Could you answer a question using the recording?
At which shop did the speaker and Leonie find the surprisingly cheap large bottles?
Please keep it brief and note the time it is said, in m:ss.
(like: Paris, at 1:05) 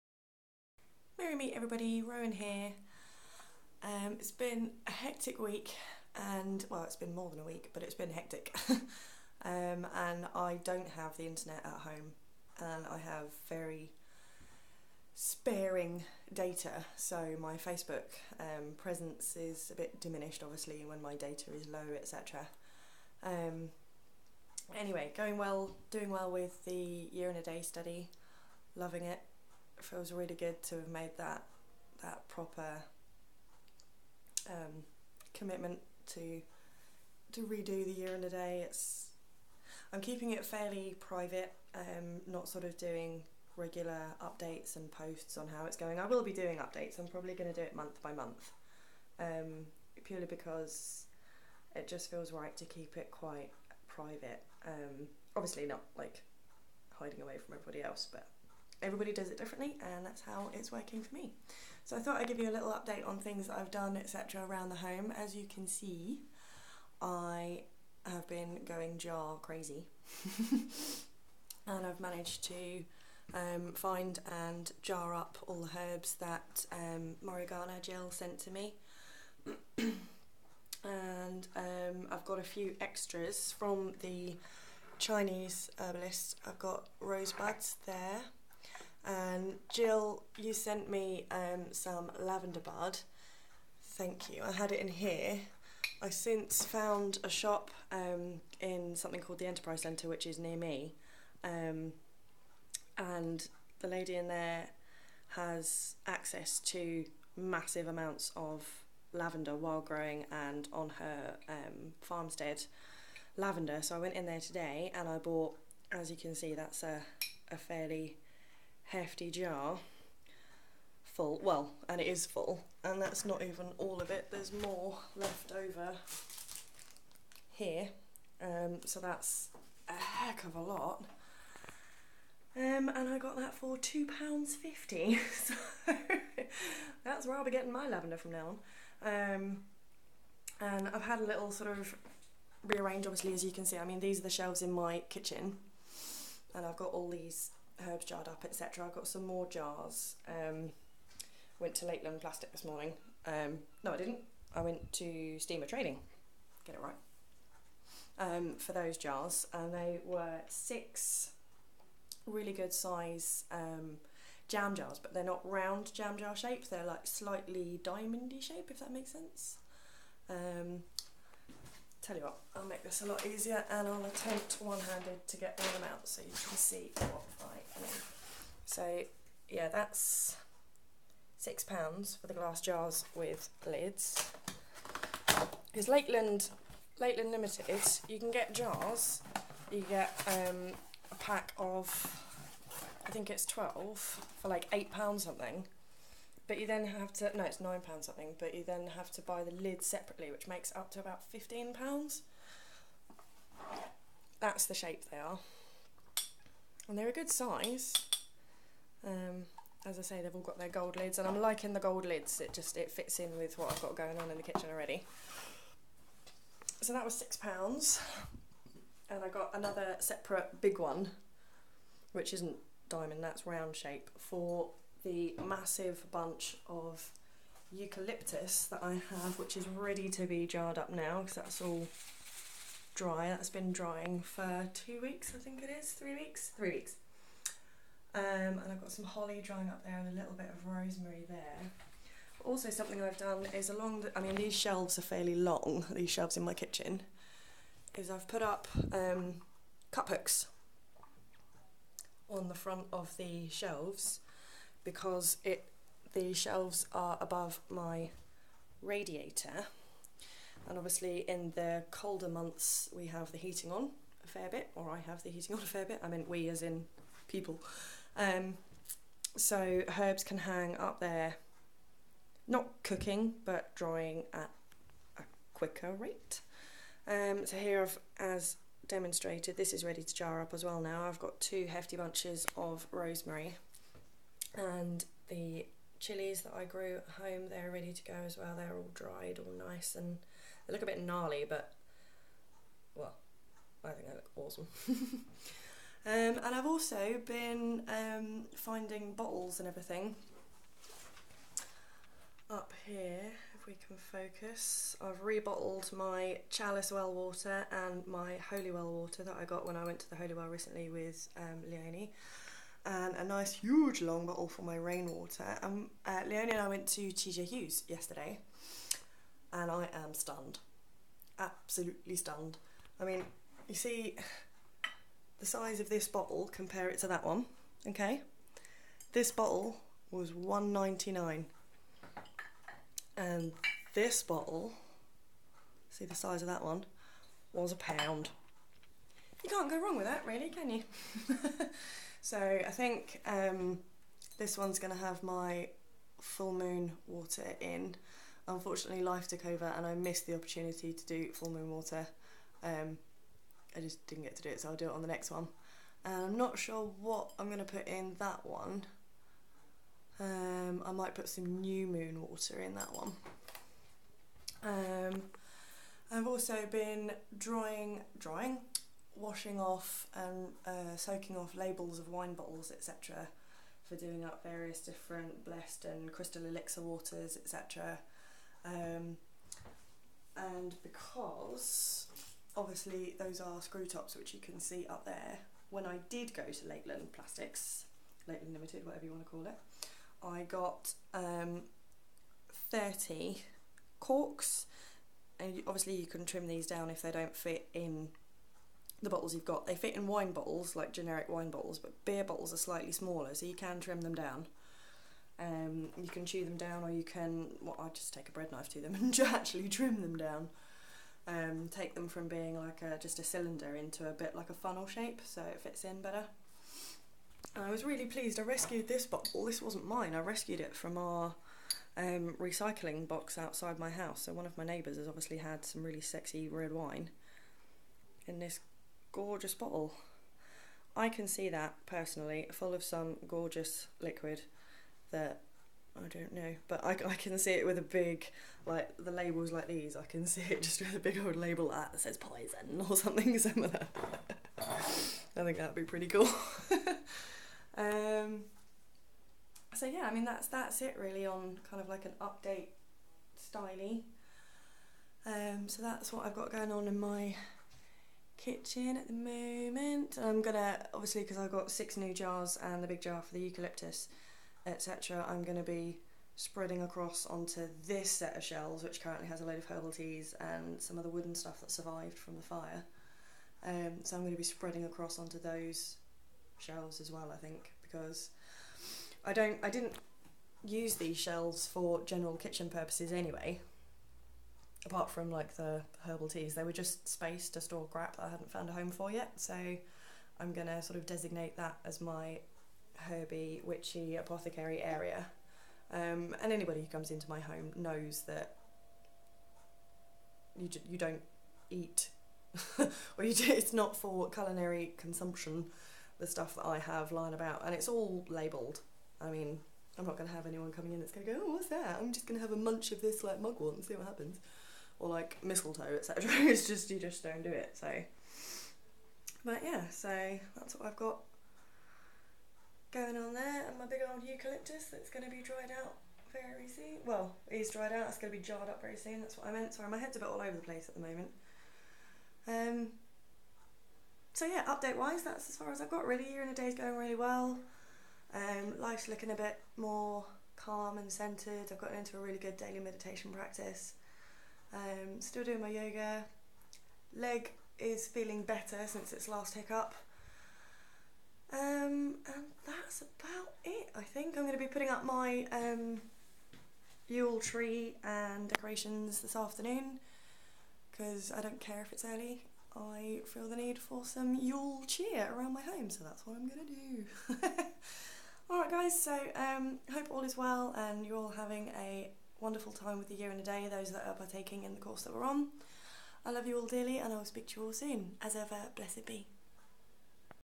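TJ Hughes, at 5:17.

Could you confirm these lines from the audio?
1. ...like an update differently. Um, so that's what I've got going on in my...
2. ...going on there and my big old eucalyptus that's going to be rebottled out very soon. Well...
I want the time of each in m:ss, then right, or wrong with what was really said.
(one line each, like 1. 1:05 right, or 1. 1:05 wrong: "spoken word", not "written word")
1. 7:31 wrong: "styly", not "differently"
2. 8:42 wrong: "dried", not "rebottled".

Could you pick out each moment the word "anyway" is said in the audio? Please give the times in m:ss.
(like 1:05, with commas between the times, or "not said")
0:24, 8:03.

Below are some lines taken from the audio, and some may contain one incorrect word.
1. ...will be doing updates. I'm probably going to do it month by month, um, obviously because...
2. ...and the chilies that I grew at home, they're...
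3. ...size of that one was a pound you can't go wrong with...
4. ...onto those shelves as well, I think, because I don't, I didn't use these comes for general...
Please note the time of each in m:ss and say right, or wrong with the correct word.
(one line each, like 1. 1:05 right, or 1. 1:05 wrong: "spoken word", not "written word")
1. 0:46 wrong: "purely", not "obviously"
2. 4:44 right
3. 5:36 right
4. 7:55 wrong: "shelves", not "comes".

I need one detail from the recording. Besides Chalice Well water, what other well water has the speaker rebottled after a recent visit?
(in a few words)
Holy well water.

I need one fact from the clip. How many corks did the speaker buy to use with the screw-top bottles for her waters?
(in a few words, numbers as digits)
30.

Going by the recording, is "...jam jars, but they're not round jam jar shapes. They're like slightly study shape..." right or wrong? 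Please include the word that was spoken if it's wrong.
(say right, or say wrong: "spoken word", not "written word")
wrong: "diamondy", not "study".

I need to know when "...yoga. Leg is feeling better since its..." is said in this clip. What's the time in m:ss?
9:05.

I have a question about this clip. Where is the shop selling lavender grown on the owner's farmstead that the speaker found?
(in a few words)
Enterprise Centre.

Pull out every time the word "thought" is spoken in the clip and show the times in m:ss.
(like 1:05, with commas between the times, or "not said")
1:01.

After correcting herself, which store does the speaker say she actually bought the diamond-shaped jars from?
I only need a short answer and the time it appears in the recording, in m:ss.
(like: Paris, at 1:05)
Steamer Trading, at 2:35.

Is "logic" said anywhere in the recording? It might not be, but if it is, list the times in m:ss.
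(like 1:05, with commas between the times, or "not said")
not said.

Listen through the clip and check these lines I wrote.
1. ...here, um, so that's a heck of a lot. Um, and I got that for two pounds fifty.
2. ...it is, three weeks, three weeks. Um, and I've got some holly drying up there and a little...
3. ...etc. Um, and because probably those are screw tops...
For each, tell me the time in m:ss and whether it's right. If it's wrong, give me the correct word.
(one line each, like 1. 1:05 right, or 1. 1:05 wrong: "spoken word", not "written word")
1. 2:07 right
2. 3:55 right
3. 6:17 wrong: "obviously", not "probably".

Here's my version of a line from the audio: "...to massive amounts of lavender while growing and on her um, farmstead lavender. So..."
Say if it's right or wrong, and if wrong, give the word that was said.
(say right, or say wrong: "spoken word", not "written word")
right.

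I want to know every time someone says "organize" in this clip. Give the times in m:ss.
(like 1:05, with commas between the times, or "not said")
not said.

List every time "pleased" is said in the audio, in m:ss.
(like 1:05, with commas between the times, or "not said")
6:58.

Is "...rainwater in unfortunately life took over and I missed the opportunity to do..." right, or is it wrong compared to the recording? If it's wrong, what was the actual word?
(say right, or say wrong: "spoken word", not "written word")
wrong: "water", not "rainwater".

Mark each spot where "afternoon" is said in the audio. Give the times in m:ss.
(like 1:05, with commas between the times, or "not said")
9:19.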